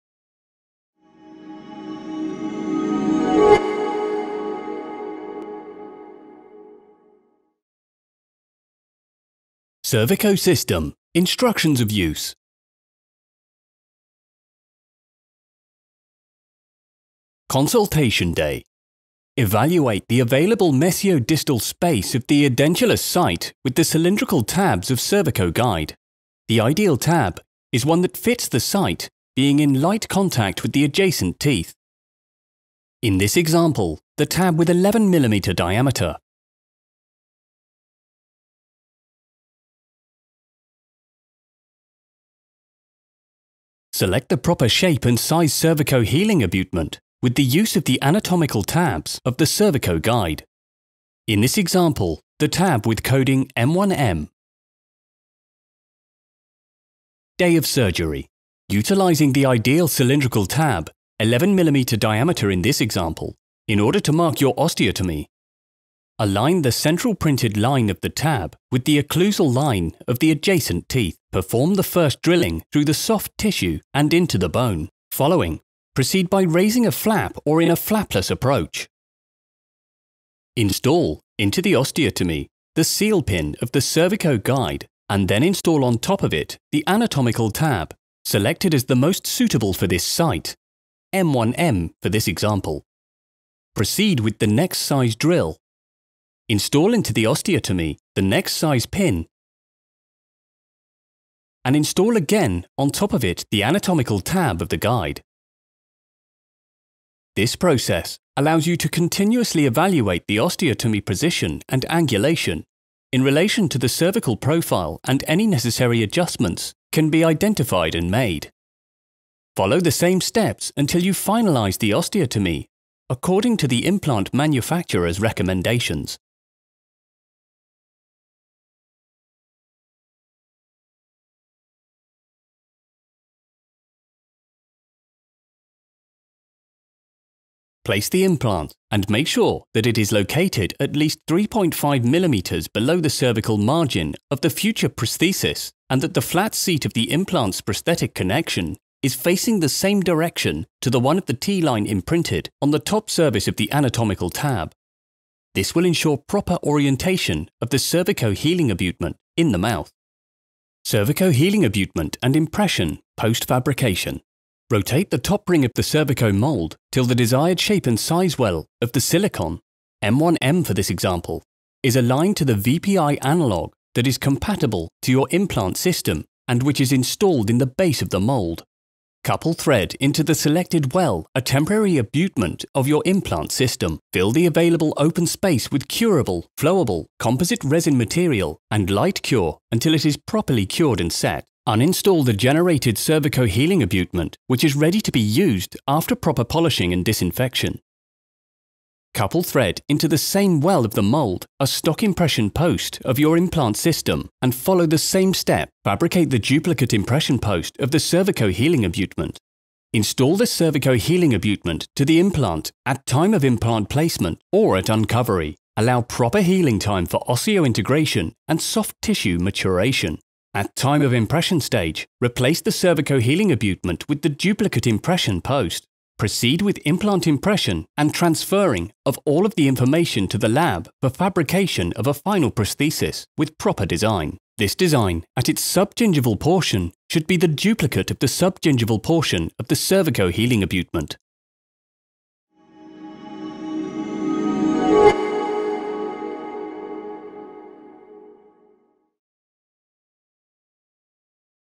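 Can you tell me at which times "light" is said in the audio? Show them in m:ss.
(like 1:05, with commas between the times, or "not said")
0:29, 3:08.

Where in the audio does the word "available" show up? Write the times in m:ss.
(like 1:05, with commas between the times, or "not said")
0:20, 3:04.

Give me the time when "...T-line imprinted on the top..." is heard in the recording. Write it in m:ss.
2:31.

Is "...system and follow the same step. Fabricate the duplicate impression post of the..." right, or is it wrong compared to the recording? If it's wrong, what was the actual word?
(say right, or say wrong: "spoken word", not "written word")
right.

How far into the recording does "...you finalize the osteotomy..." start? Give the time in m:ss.
2:01.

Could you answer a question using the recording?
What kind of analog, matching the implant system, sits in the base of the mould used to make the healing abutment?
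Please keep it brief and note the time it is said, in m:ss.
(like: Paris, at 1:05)
VPI analog, at 2:52.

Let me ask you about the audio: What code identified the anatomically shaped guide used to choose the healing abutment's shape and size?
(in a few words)
M1M.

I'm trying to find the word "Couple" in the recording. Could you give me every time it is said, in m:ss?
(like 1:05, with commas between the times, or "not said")
2:59, 3:19.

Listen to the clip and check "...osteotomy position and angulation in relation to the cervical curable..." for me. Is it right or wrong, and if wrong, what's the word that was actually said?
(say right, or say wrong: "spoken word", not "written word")
wrong: "profile", not "curable".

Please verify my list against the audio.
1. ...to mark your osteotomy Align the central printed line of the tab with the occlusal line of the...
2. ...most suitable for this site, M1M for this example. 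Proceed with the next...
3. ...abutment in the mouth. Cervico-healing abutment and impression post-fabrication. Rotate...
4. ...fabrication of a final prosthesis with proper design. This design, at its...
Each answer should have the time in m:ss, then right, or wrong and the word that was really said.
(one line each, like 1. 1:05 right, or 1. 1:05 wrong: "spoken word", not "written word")
1. 1:03 right
2. 1:28 right
3. 2:38 right
4. 3:51 right.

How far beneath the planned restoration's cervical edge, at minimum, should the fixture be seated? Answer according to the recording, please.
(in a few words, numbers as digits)
3.5 mm.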